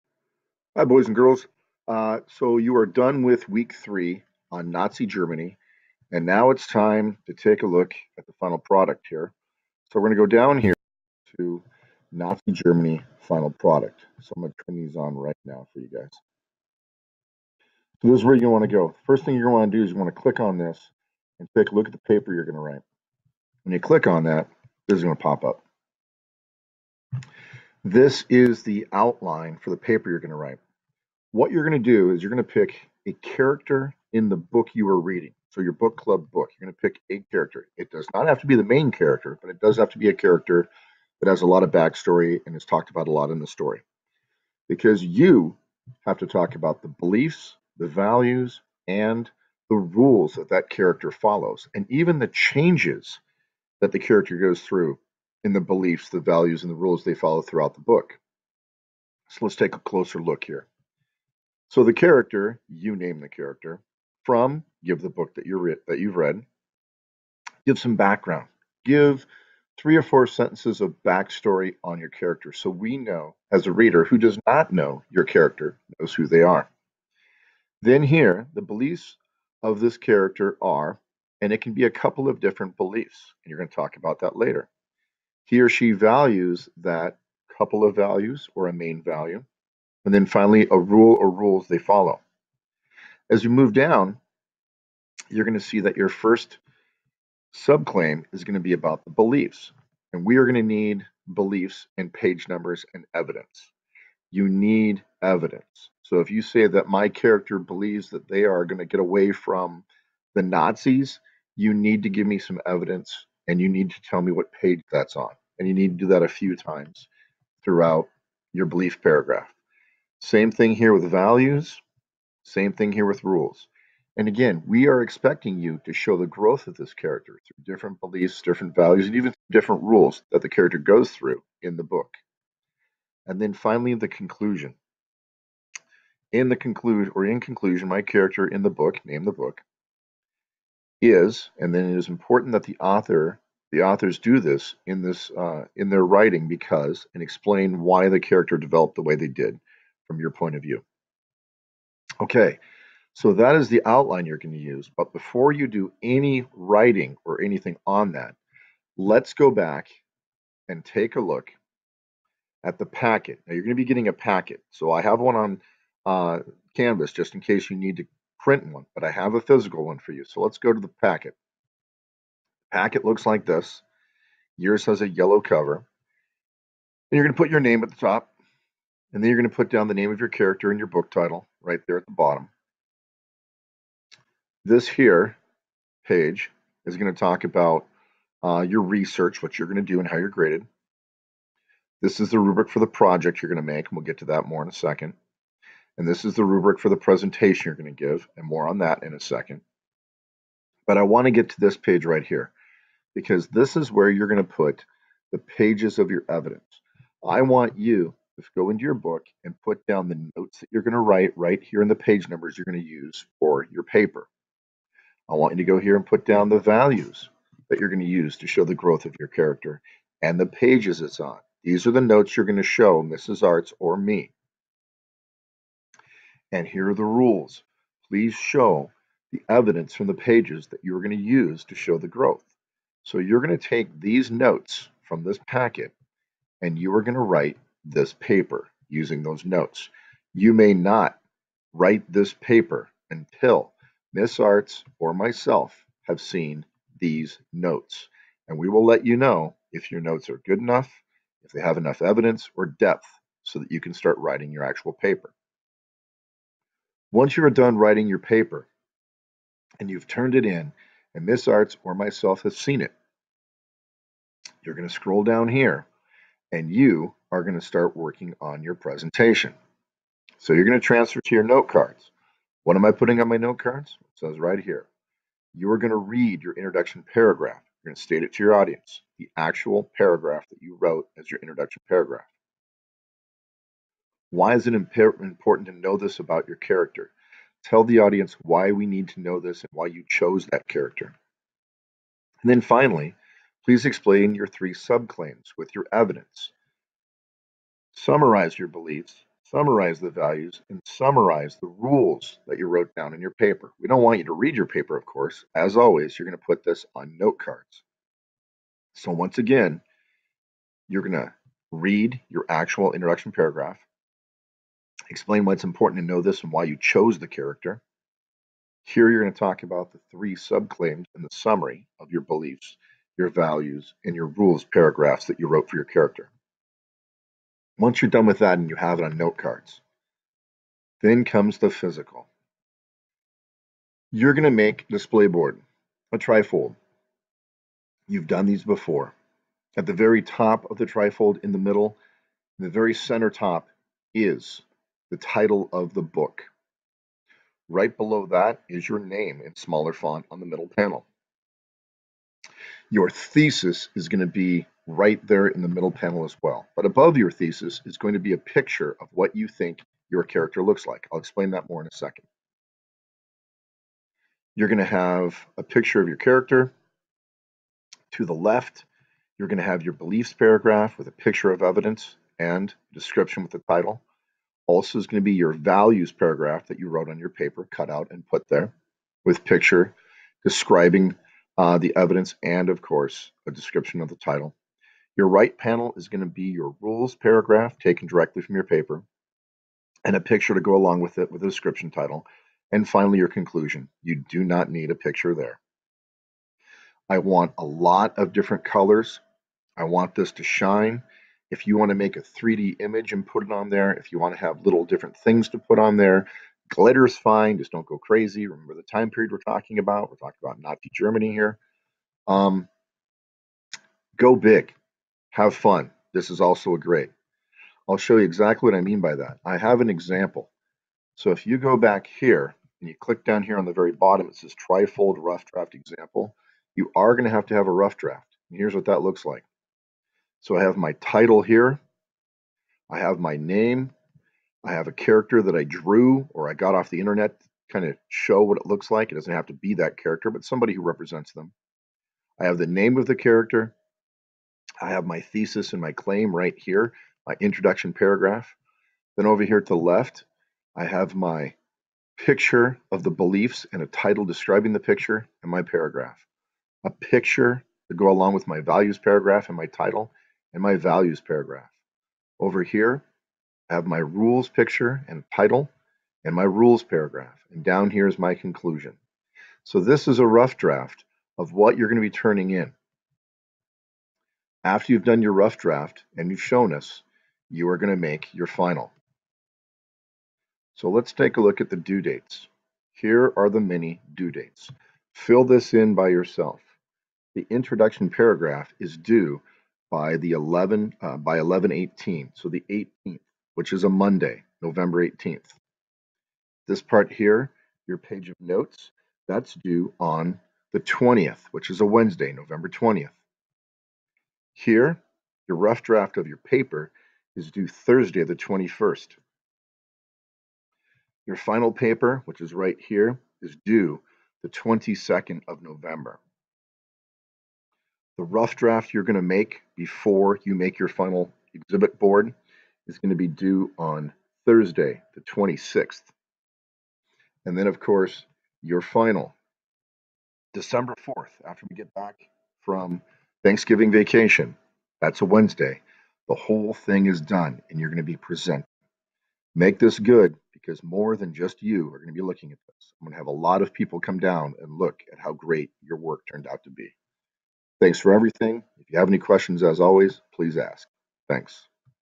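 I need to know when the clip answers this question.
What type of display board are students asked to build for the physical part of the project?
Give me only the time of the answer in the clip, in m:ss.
5:36.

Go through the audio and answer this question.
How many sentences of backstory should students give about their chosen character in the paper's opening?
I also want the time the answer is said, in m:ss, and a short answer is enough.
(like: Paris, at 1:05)
3 or 4, at 1:09.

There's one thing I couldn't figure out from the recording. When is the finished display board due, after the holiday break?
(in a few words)
December 4.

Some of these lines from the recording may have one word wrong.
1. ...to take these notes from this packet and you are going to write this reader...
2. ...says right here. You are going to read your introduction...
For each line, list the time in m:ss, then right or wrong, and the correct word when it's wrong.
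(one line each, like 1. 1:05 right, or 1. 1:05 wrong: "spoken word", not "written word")
1. 3:53 wrong: "paper", not "reader"
2. 4:34 right.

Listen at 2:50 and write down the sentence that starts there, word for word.
So let's go to the packet.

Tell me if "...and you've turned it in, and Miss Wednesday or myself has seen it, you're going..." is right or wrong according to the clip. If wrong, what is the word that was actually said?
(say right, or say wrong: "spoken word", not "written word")
wrong: "Arts", not "Wednesday".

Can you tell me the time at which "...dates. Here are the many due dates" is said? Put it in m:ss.
8:02.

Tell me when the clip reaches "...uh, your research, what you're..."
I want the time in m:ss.
3:08.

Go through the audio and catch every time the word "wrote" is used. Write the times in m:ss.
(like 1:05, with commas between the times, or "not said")
4:40, 5:02, 5:25, 6:16.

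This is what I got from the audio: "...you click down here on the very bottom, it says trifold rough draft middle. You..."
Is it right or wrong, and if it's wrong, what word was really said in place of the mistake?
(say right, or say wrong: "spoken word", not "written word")
wrong: "example", not "middle".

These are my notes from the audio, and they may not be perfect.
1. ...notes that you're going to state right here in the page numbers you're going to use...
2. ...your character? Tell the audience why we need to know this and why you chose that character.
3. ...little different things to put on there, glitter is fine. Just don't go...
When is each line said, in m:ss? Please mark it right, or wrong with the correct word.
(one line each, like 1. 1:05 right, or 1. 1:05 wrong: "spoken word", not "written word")
1. 3:30 wrong: "write", not "state"
2. 4:46 right
3. 6:44 right.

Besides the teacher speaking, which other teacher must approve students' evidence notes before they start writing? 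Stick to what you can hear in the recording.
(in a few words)
Mrs. Arts.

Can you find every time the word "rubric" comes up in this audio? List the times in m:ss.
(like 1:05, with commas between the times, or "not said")
3:12, 3:16.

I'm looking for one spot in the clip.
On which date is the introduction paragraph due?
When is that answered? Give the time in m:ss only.
8:14.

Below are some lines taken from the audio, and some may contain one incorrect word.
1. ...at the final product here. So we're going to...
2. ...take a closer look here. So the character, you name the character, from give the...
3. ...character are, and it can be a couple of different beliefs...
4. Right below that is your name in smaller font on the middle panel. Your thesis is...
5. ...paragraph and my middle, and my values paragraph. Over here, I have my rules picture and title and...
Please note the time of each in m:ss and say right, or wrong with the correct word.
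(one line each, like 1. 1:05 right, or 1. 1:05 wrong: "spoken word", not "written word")
1. 0:08 right
2. 0:59 right
3. 1:19 right
4. 5:47 right
5. 7:38 wrong: "title", not "middle".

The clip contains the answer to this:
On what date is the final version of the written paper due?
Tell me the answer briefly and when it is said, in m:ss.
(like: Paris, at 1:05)
November 22, at 8:34.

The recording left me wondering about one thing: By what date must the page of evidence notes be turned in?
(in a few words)
November 20.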